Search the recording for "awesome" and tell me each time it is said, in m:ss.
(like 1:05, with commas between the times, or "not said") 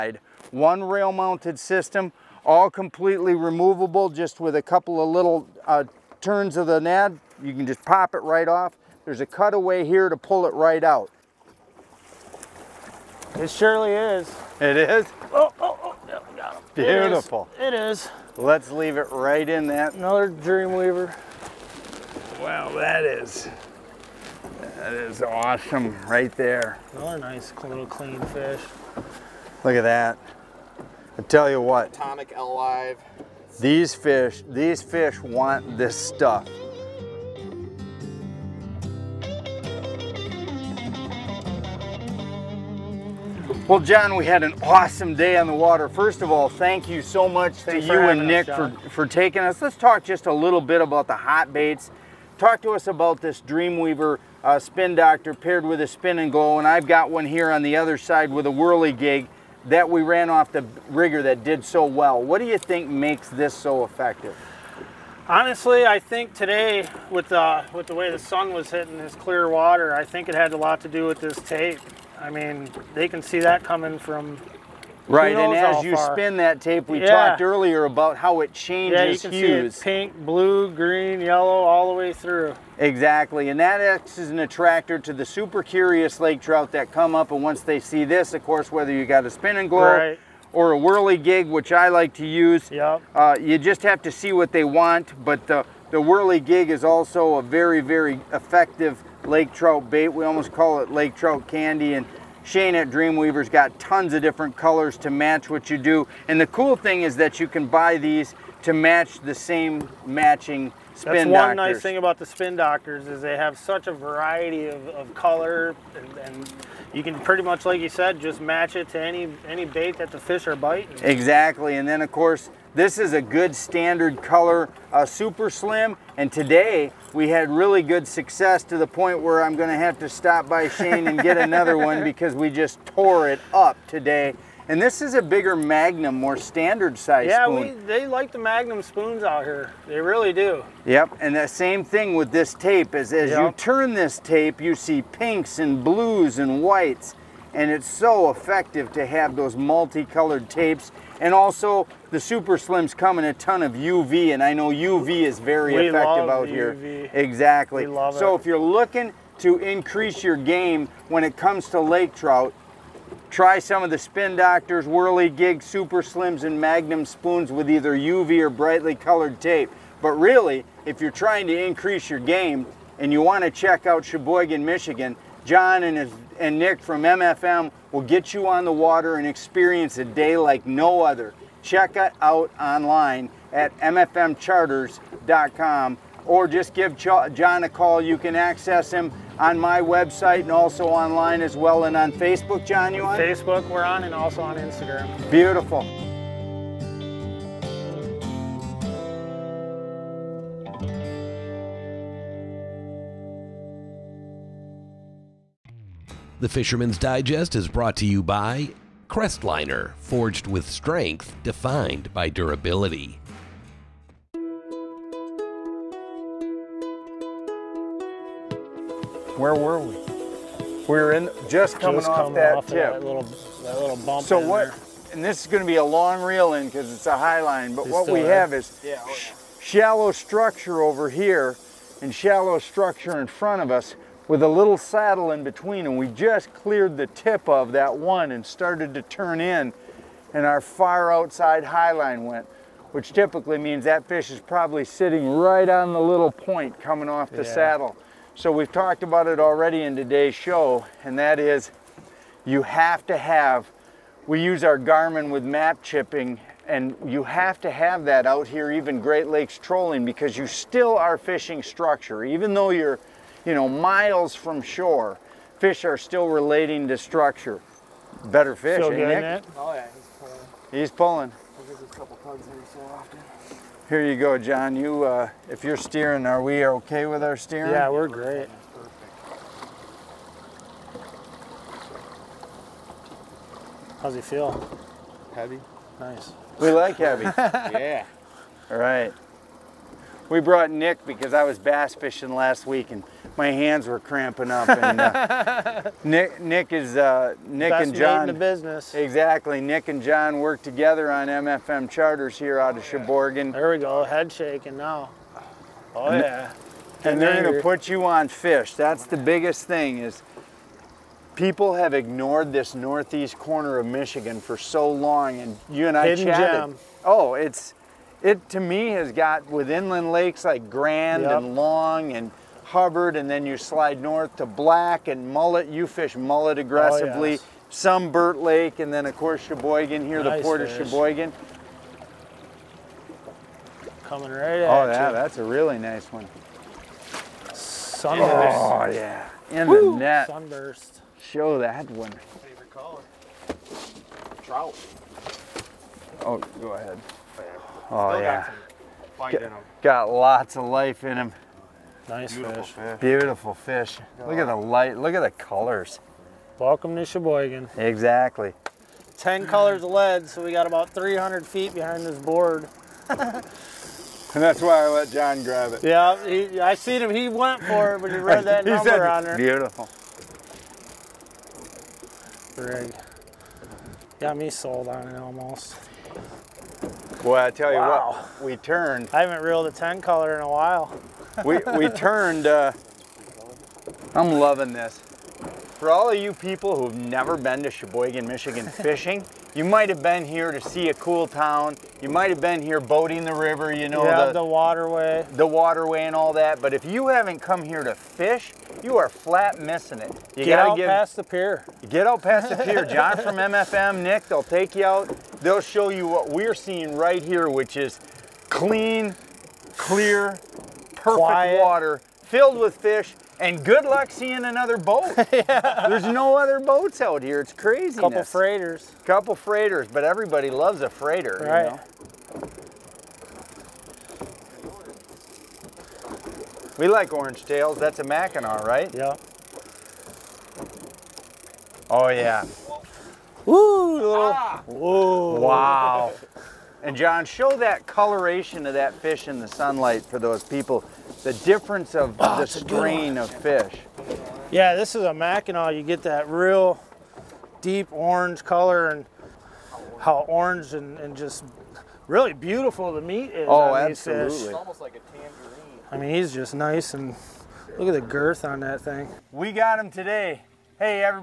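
0:25, 0:44.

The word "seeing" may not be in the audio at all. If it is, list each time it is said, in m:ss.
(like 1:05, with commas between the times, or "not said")
6:46, 6:54.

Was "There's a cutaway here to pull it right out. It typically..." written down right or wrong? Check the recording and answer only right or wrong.
wrong.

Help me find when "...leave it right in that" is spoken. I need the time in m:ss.
0:18.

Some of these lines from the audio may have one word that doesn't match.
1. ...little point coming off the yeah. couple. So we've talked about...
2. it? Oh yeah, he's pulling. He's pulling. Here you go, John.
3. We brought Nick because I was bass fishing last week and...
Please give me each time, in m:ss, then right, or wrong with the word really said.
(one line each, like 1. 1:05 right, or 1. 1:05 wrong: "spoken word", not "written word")
1. 4:05 wrong: "saddle", not "couple"
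2. 4:29 right
3. 4:50 right.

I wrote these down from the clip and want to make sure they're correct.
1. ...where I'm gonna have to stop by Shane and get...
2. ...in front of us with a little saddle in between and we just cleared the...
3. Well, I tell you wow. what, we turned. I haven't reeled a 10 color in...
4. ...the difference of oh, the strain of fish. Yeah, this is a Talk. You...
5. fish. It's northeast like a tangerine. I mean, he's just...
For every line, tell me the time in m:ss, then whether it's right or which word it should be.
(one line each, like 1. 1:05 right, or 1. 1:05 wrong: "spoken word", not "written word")
1. 2:09 right
2. 3:53 right
3. 6:17 right
4. 7:21 wrong: "Mackinaw", not "Talk"
5. 7:34 wrong: "almost", not "northeast".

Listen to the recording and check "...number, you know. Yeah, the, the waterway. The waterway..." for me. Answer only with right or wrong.
wrong.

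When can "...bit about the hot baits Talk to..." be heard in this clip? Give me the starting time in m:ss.
0:50.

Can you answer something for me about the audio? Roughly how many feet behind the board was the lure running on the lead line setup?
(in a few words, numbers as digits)
300 feet.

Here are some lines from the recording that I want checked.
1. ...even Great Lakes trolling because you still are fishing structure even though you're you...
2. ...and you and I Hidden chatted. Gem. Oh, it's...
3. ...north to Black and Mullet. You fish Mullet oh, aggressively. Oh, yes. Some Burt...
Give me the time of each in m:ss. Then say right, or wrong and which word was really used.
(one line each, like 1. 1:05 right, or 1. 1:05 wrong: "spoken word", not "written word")
1. 4:18 right
2. 5:15 right
3. 5:23 right.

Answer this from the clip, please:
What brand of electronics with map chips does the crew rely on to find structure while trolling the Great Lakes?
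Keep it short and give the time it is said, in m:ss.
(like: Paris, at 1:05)
Garmin, at 4:14.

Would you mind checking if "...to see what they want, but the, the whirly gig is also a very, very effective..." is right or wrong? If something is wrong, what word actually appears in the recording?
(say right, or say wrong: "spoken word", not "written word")
right.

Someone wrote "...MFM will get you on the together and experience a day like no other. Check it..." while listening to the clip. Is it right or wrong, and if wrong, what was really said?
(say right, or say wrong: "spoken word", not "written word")
wrong: "water", not "together".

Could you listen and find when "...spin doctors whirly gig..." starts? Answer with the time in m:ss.
2:43.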